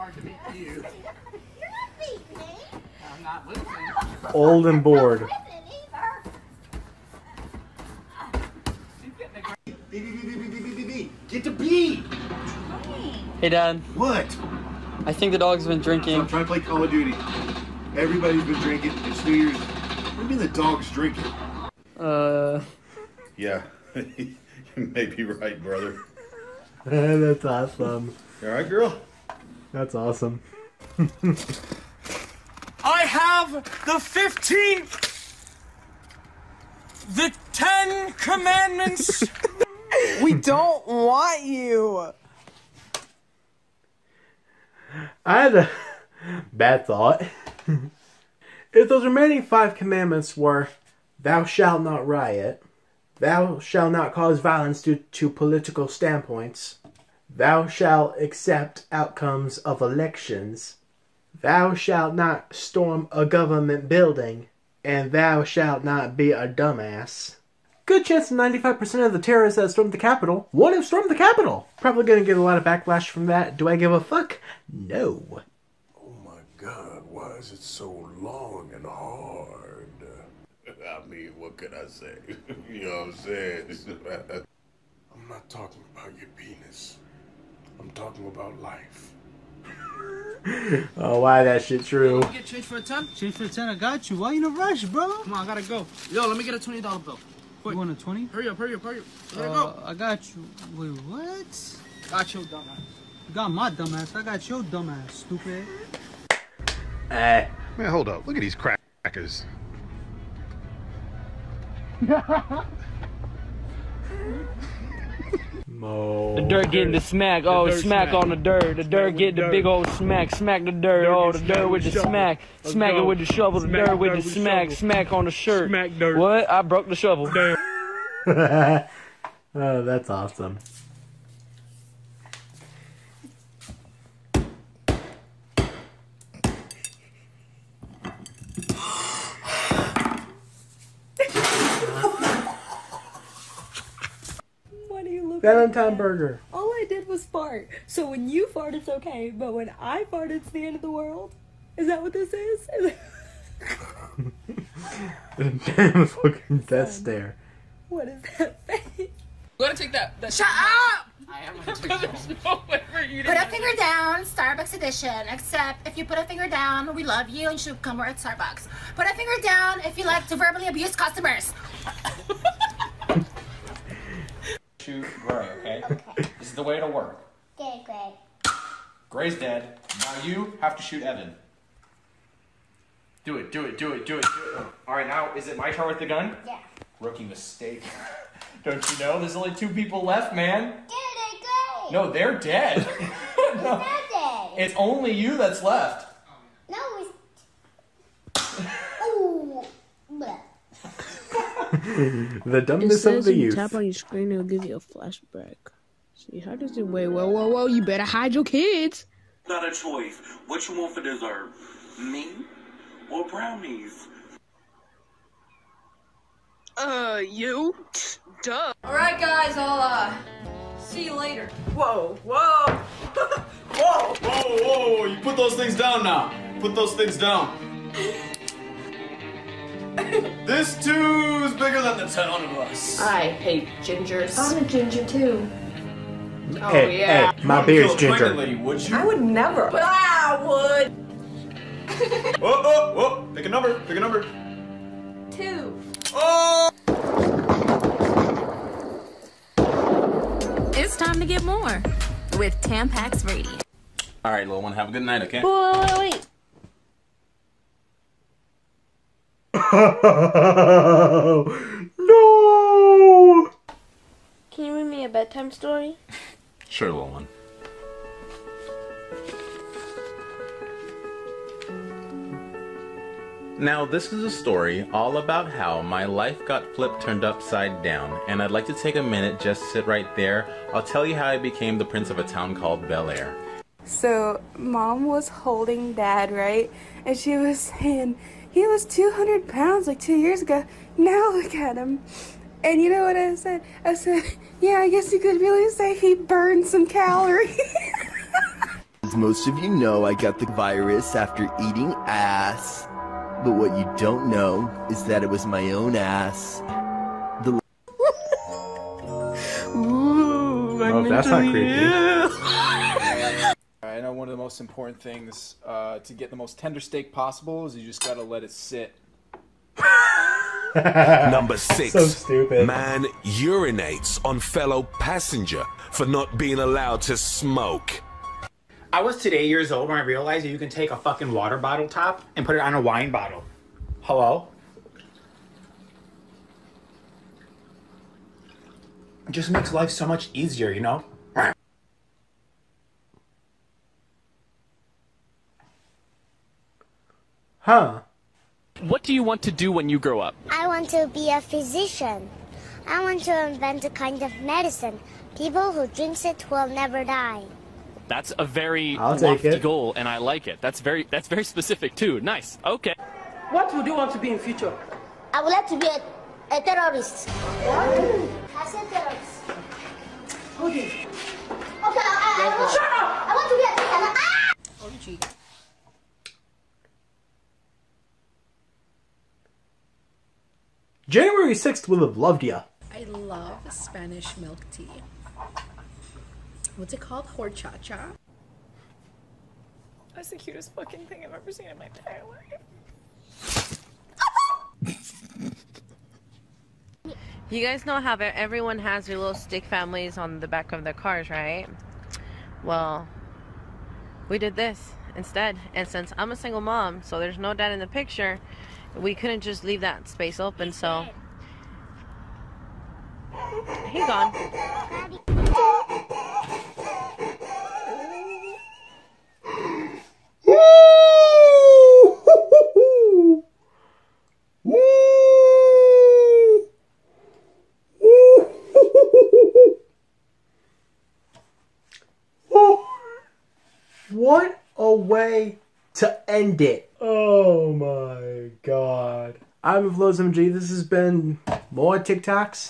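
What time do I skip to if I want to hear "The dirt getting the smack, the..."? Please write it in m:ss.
1:56.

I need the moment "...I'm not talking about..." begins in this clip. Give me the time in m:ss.
1:25.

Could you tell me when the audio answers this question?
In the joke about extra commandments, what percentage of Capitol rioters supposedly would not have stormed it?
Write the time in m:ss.
1:08.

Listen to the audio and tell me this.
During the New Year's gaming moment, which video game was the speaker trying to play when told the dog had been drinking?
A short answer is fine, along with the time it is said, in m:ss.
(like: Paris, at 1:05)
Call of Duty, at 0:16.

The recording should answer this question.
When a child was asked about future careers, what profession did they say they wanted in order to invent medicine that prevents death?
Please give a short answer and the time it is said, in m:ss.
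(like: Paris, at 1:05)
physician, at 5:51.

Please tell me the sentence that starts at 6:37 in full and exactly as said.
you guys know how everyone has their little stick families on the back of their cars, right?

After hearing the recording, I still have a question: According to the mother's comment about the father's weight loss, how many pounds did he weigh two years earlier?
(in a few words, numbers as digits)
200.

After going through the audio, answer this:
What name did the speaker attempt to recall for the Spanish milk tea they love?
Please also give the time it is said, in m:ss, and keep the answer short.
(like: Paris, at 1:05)
Horchacha, at 6:27.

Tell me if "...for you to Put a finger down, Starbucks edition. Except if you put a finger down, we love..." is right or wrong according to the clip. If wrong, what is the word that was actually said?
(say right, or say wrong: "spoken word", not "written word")
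right.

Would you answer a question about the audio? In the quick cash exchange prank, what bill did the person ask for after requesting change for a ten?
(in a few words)
20 dollar bill.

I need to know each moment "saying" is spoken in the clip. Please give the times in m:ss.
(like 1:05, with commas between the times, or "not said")
1:23, 4:47.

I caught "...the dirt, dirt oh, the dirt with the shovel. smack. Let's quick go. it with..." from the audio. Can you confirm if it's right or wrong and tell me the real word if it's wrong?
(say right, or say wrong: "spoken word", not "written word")
wrong: "smack", not "quick".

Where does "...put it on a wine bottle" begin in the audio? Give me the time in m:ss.
5:32.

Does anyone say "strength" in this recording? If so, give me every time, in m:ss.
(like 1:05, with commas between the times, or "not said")
not said.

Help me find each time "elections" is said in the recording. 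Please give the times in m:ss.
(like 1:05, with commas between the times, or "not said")
0:59.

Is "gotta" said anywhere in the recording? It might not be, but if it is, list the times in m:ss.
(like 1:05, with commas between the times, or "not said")
1:35, 2:39, 5:18.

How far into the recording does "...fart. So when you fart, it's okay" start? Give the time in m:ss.
2:27.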